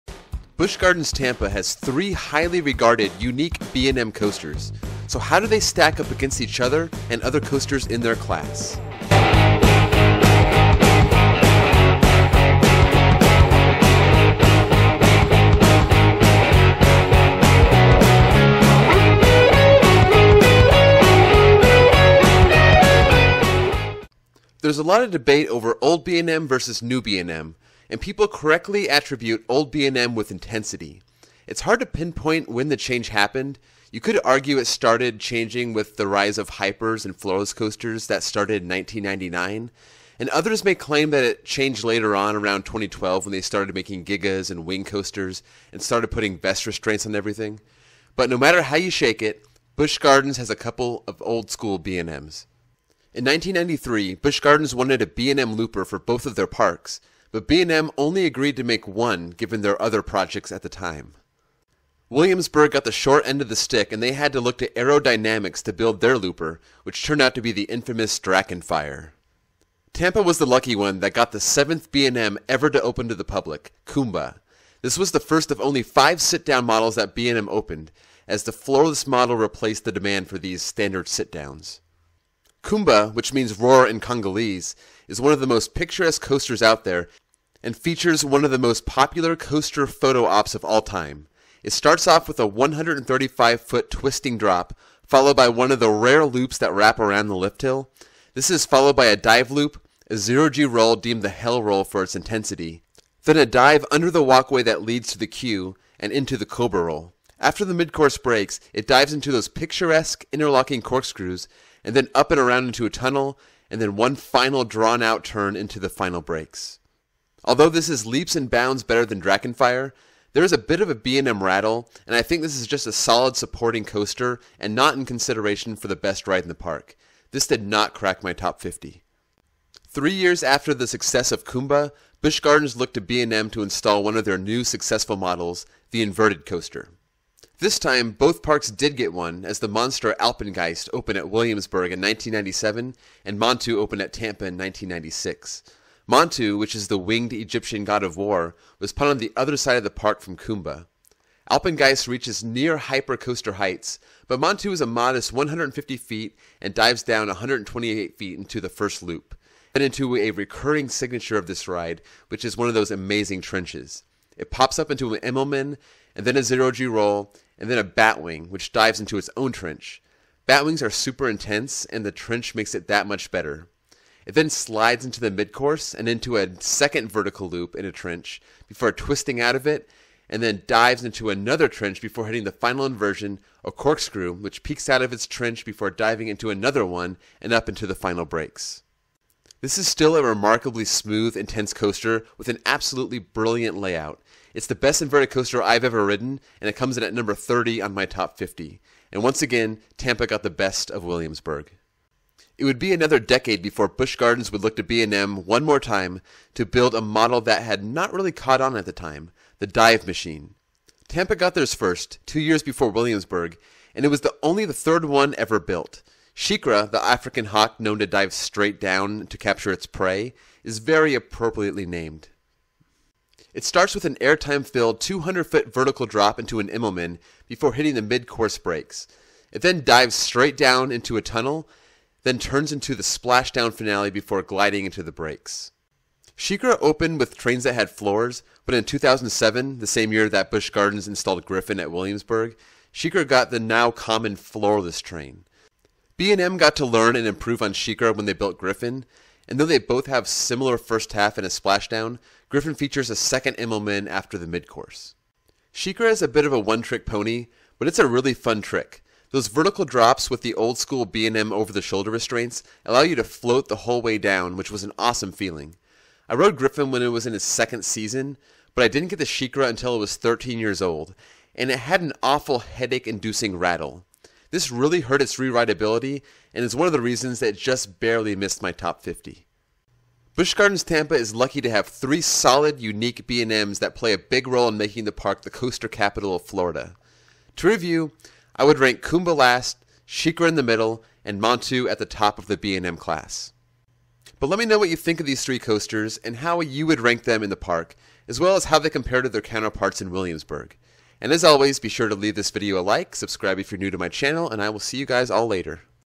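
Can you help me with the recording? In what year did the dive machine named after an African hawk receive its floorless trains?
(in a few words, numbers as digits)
2007.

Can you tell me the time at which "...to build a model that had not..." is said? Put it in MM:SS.
03:26.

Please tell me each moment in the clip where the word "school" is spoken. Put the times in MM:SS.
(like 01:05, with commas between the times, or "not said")
00:51, 04:20.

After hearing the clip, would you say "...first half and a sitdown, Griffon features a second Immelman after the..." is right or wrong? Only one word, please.
wrong.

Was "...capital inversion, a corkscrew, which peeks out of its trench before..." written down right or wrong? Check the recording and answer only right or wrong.
wrong.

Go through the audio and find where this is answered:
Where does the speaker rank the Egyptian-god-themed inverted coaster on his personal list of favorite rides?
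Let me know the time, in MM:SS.
03:17.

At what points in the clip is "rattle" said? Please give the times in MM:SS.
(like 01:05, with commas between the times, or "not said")
02:01, 04:33.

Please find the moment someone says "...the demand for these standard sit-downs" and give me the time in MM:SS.
01:19.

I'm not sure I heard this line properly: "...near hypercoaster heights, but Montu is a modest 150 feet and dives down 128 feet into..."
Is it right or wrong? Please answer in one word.
right.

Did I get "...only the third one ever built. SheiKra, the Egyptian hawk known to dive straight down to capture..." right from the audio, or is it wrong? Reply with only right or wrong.
wrong.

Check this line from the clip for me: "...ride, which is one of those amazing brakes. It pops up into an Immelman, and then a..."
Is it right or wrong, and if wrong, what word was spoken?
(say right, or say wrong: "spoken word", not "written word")
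wrong: "trenches", not "brakes".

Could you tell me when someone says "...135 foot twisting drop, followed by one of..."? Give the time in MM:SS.
01:32.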